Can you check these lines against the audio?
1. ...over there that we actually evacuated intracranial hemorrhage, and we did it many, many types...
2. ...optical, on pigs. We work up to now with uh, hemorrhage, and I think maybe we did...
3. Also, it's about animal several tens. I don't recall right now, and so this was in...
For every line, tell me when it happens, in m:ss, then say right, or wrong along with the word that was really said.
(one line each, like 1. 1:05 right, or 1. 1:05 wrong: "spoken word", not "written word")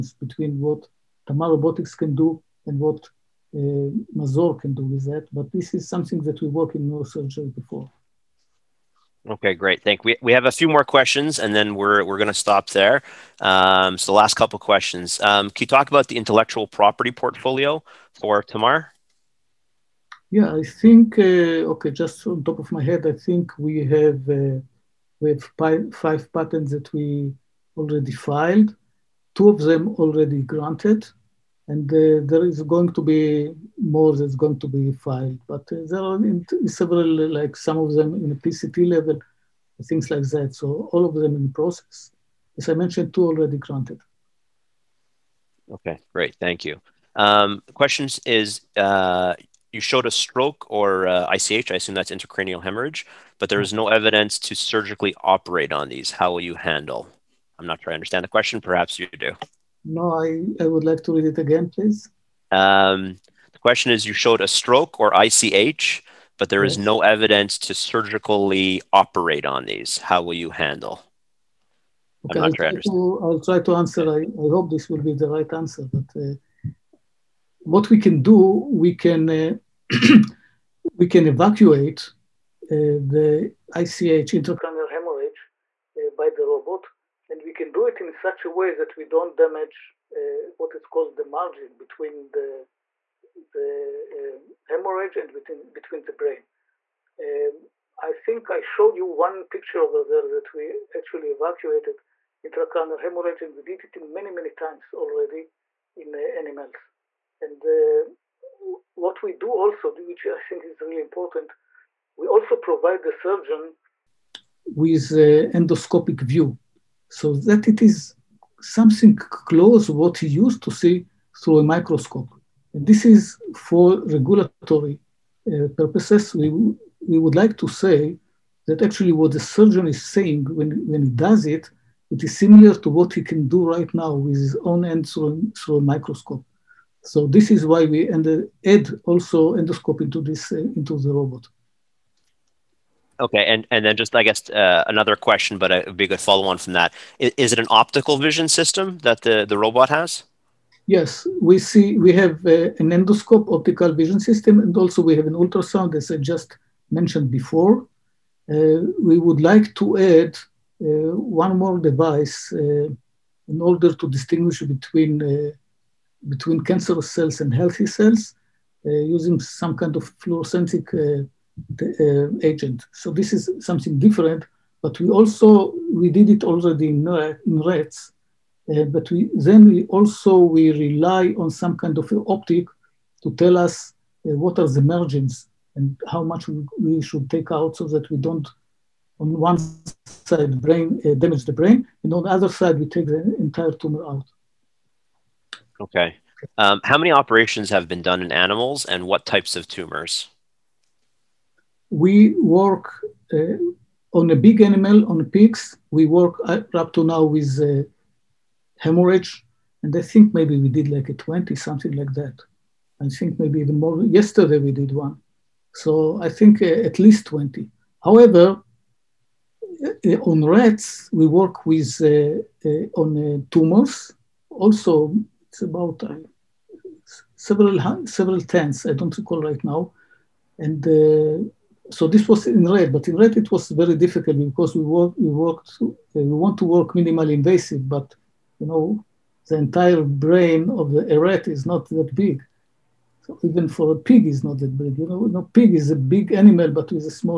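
1. 1:39 wrong: "times", not "types"
2. 3:24 wrong: "animal", not "optical"
3. 3:44 wrong: "several", not "animal".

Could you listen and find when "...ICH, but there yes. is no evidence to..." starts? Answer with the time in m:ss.
1:05.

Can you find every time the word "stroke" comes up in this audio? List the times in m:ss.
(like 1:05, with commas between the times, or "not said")
0:50, 1:04.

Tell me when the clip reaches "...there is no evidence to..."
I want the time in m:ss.
0:53.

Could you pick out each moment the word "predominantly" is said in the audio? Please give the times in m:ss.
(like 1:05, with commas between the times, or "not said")
not said.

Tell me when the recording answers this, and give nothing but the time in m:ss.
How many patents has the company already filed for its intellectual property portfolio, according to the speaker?
0:25.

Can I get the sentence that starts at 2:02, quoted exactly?
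And this is for regulatory uh, purposes.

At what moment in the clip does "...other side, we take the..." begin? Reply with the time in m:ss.
3:12.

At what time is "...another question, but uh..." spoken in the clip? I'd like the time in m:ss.
2:24.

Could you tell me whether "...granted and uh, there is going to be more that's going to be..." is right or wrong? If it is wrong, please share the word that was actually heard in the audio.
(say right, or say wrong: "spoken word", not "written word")
right.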